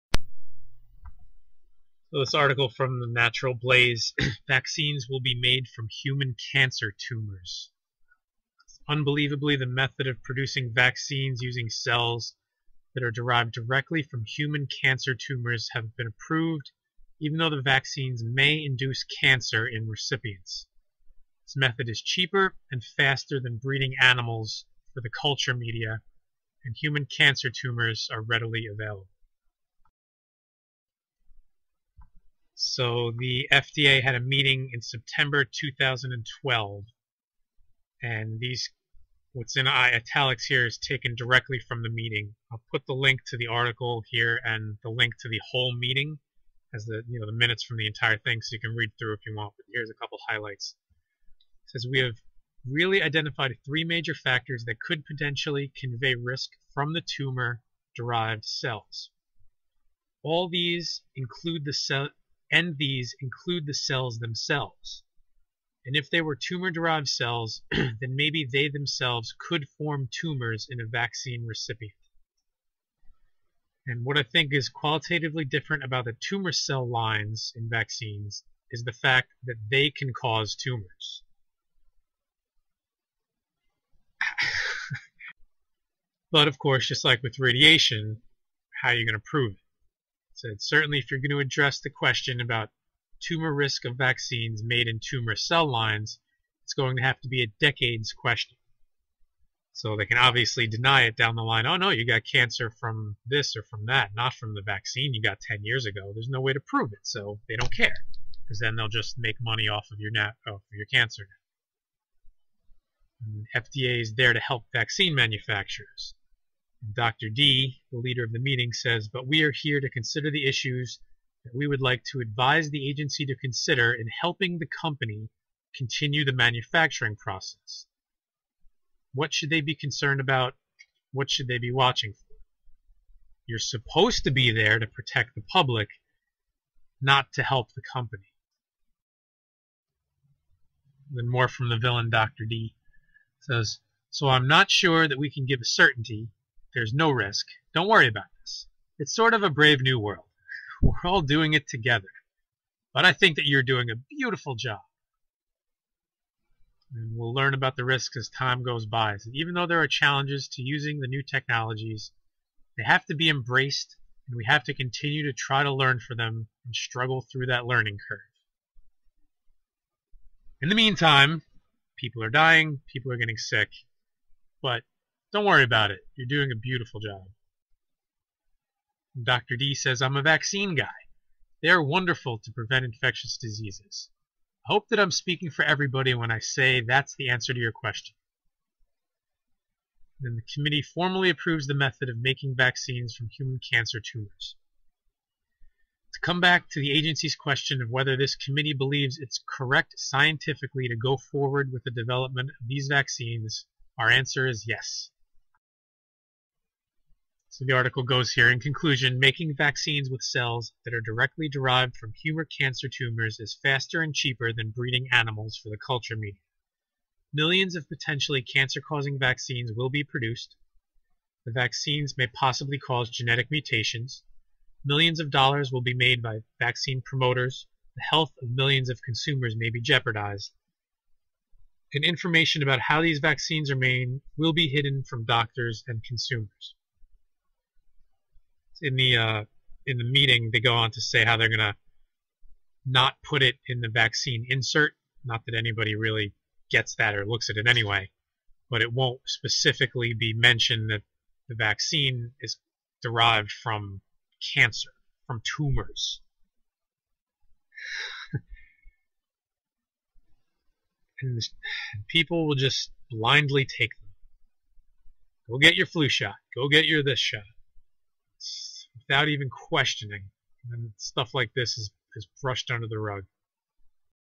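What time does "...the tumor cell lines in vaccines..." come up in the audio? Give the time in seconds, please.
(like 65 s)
76 s.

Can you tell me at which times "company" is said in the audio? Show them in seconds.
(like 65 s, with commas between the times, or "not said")
124 s, 137 s.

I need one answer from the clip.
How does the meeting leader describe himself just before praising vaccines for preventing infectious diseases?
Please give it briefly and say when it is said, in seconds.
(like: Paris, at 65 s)
a vaccine guy, at 180 s.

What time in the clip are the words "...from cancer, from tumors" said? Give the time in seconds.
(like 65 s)
253 s.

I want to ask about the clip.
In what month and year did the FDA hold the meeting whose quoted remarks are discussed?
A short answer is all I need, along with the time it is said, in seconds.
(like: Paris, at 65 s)
September 2012, at 34 s.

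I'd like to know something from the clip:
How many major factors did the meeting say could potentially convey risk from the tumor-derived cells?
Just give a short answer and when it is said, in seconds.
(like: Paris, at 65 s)
3, at 53 s.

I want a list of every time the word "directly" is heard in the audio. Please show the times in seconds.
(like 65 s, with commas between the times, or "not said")
13 s, 41 s, 210 s.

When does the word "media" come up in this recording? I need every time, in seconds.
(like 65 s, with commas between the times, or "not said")
25 s, 216 s.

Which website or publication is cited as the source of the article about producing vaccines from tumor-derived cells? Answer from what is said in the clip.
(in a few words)
Natural Blaze.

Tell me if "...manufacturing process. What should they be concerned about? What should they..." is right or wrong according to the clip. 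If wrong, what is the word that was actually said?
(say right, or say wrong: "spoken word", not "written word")
right.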